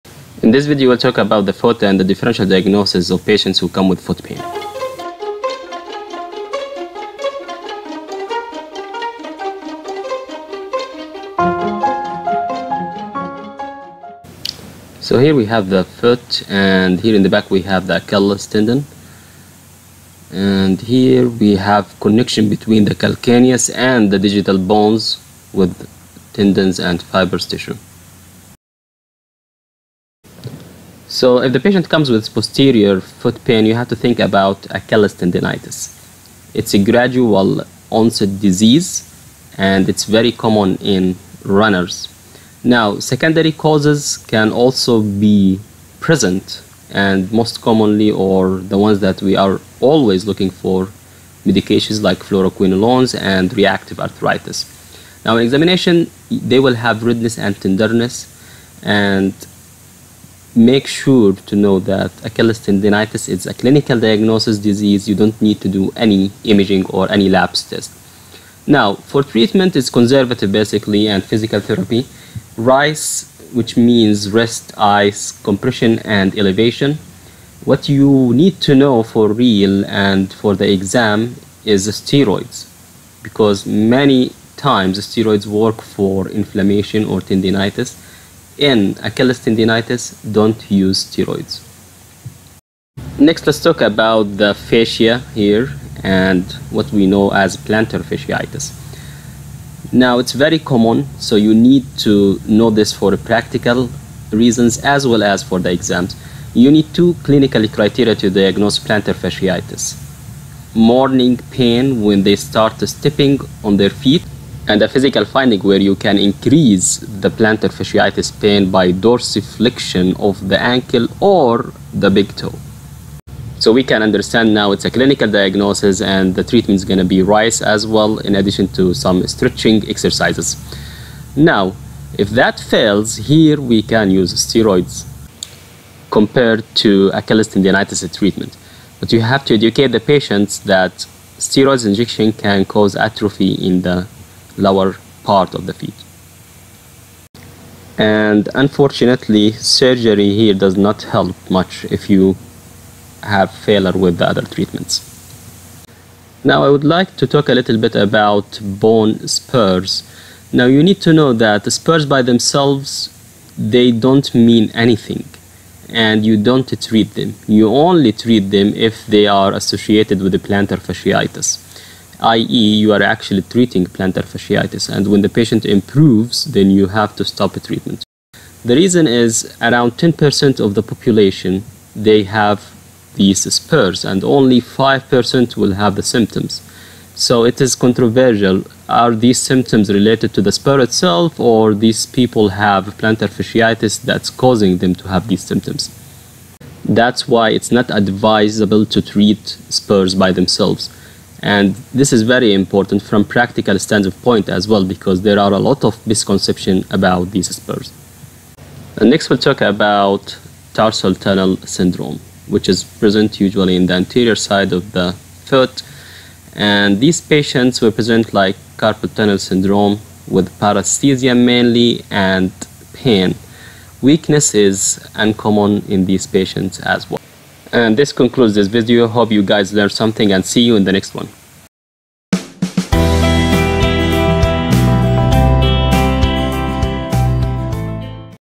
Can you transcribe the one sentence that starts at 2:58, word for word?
The reason is around 10% of the population they have these spurs, and only 5% will have the symptoms.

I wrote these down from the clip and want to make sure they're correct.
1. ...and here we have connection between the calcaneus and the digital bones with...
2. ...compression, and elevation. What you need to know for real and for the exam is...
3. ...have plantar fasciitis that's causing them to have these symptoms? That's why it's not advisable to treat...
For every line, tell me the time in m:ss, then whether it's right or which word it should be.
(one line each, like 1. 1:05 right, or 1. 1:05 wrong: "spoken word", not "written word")
1. 0:20 right
2. 1:15 right
3. 3:12 right.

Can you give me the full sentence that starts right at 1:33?
Next, let's talk about the fascia here and what we know as plantar fasciitis.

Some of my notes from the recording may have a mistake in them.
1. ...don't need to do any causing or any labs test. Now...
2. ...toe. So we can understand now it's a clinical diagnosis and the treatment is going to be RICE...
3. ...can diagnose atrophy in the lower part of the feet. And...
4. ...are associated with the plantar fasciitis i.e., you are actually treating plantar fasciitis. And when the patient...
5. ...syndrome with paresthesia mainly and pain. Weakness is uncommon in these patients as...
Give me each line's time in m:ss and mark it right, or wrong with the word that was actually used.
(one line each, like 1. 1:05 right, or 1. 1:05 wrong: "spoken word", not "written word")
1. 1:05 wrong: "imaging", not "causing"
2. 2:02 right
3. 2:22 wrong: "cause", not "diagnose"
4. 2:49 right
5. 3:39 right.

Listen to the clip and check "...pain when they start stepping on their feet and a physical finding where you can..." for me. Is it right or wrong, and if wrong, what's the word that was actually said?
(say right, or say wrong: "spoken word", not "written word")
right.